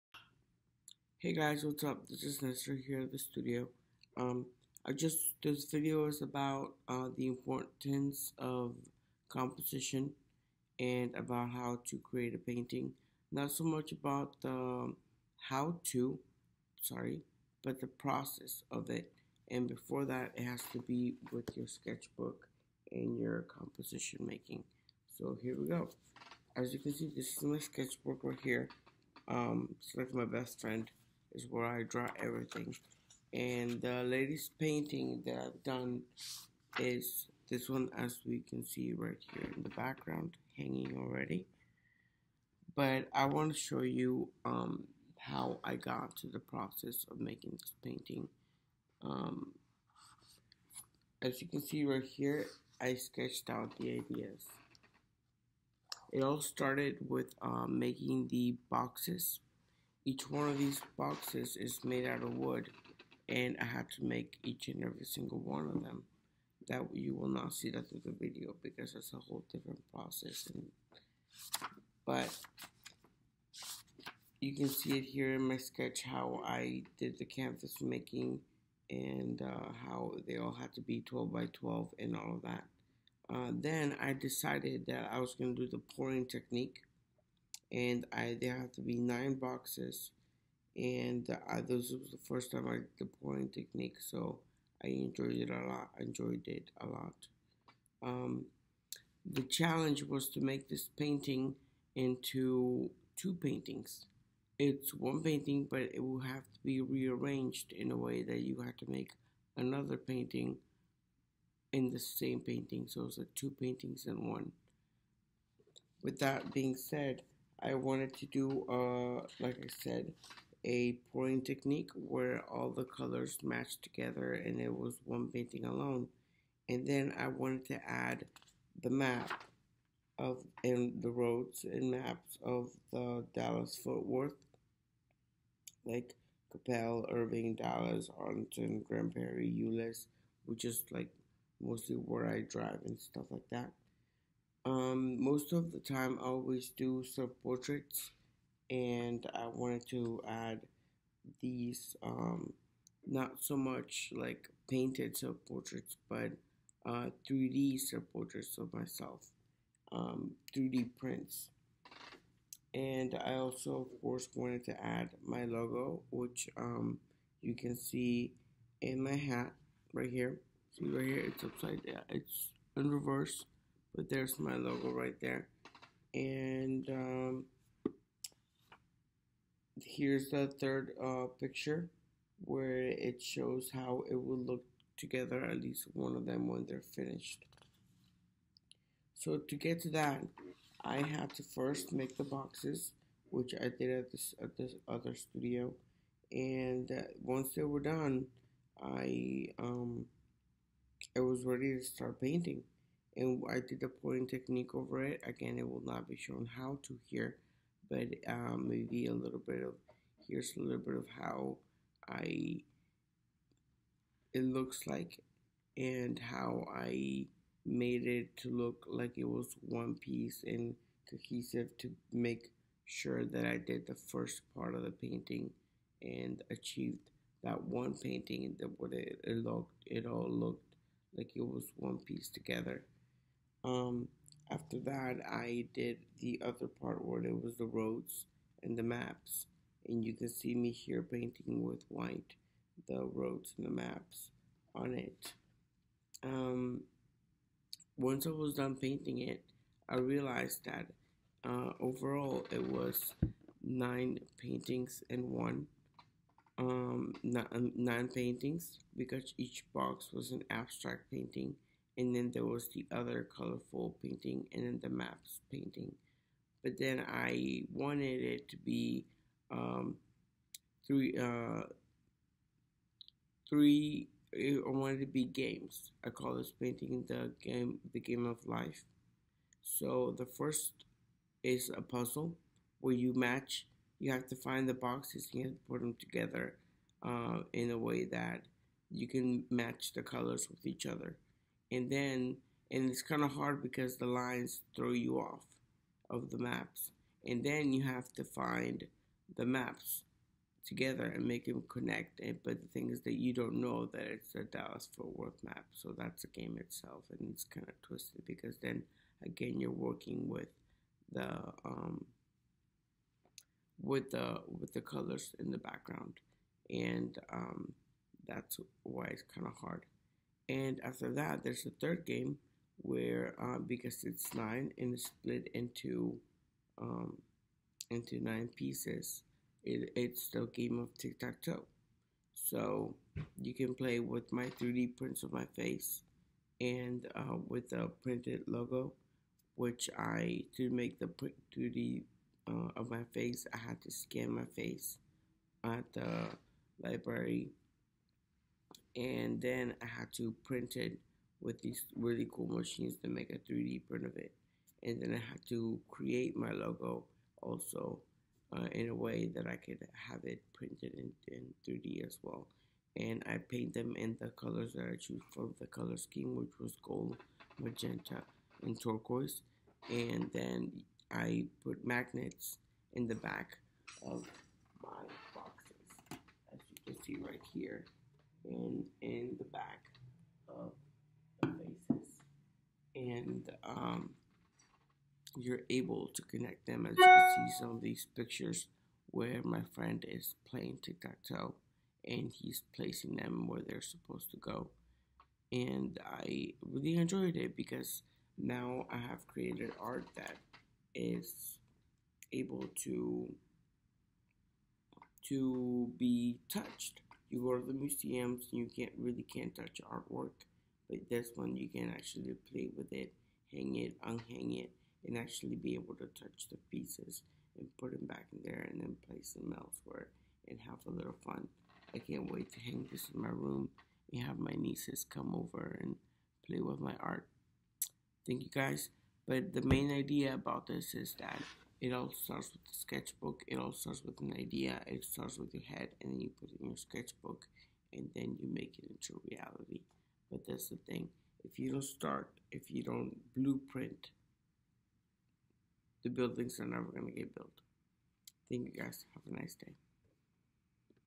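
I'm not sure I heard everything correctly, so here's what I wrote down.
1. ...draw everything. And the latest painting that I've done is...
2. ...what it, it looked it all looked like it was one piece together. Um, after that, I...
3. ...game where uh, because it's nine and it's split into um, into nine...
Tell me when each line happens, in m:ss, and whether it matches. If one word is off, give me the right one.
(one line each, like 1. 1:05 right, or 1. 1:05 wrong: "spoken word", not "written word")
1. 0:31 right
2. 3:48 right
3. 5:22 right.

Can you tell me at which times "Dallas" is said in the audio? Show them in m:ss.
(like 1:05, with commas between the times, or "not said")
2:13, 2:17, 5:04.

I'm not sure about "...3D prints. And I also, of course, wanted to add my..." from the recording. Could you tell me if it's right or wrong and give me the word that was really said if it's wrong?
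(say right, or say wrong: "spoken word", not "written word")
right.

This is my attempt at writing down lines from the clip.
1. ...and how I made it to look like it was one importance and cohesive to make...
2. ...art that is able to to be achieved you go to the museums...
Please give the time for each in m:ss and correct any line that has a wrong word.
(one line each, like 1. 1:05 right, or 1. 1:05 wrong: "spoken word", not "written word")
1. 3:35 wrong: "piece", not "importance"
2. 6:39 wrong: "touched", not "achieved".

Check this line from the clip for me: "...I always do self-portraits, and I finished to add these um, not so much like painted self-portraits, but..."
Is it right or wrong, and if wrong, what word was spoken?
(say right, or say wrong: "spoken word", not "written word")
wrong: "wanted", not "finished".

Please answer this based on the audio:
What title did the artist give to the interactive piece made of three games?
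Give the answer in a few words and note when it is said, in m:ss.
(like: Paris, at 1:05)
The Game of Life, at 4:37.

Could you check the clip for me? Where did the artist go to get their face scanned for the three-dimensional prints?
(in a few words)
The library.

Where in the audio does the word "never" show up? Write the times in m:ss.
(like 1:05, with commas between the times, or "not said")
7:26.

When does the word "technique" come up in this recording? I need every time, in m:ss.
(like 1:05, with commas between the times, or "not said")
1:26, 1:33, 2:01, 3:24.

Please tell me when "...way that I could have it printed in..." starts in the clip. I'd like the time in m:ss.
5:58.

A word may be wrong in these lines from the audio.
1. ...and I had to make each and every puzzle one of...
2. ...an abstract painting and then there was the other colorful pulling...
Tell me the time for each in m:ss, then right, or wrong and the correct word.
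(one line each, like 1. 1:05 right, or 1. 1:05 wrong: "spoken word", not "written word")
1. 1:03 wrong: "single", not "puzzle"
2. 4:20 wrong: "painting", not "pulling".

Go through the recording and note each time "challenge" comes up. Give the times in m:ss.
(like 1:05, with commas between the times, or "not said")
1:39.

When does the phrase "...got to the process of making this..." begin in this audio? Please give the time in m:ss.
0:45.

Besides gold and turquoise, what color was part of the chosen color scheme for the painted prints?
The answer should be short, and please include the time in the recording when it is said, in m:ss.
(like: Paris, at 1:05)
Magenta, at 6:07.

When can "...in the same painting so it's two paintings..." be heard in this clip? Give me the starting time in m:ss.
1:51.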